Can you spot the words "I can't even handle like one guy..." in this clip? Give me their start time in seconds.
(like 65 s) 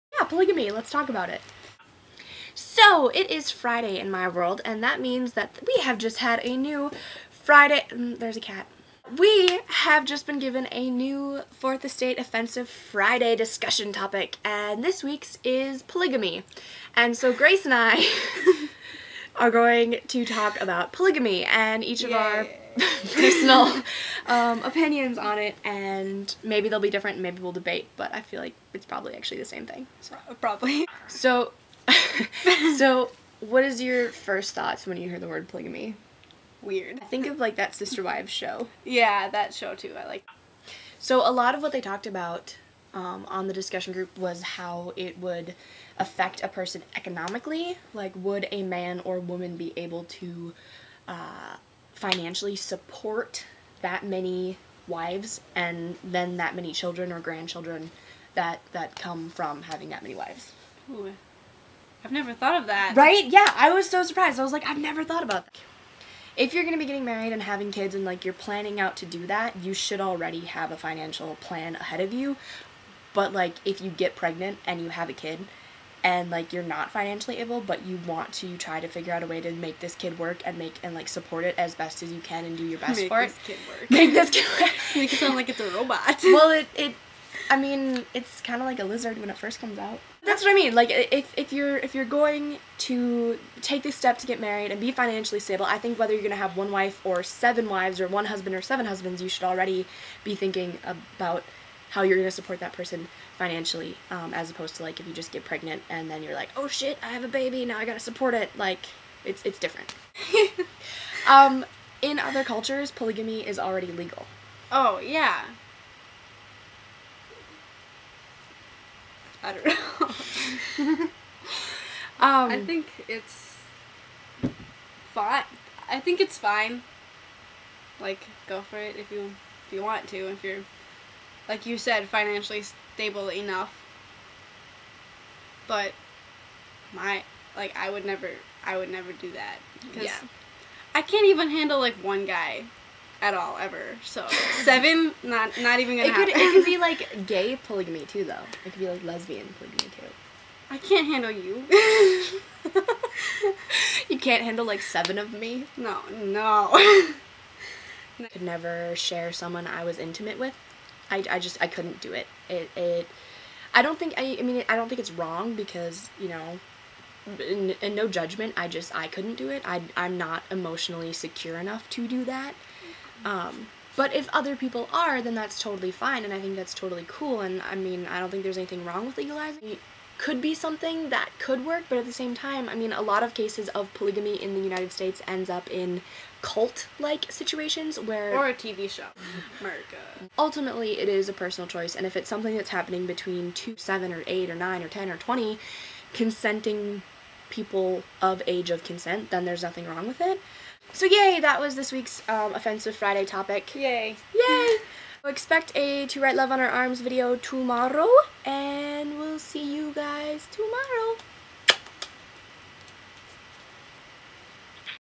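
140 s.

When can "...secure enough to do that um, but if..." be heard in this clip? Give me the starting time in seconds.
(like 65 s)
171 s.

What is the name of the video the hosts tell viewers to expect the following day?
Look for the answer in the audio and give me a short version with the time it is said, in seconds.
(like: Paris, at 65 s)
To Write Love on Her Arms, at 206 s.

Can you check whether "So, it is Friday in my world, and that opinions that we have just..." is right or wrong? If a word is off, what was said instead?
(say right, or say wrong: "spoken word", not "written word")
wrong: "means", not "opinions".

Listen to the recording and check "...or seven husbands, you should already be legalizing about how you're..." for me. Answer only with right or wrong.
wrong.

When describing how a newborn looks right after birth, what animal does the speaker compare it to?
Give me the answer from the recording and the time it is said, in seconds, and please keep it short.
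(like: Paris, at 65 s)
a lizard, at 88 s.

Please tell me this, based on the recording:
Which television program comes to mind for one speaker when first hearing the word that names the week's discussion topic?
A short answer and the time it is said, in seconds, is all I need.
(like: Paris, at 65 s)
Sister Wives, at 37 s.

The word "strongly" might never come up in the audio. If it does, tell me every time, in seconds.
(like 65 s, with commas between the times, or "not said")
not said.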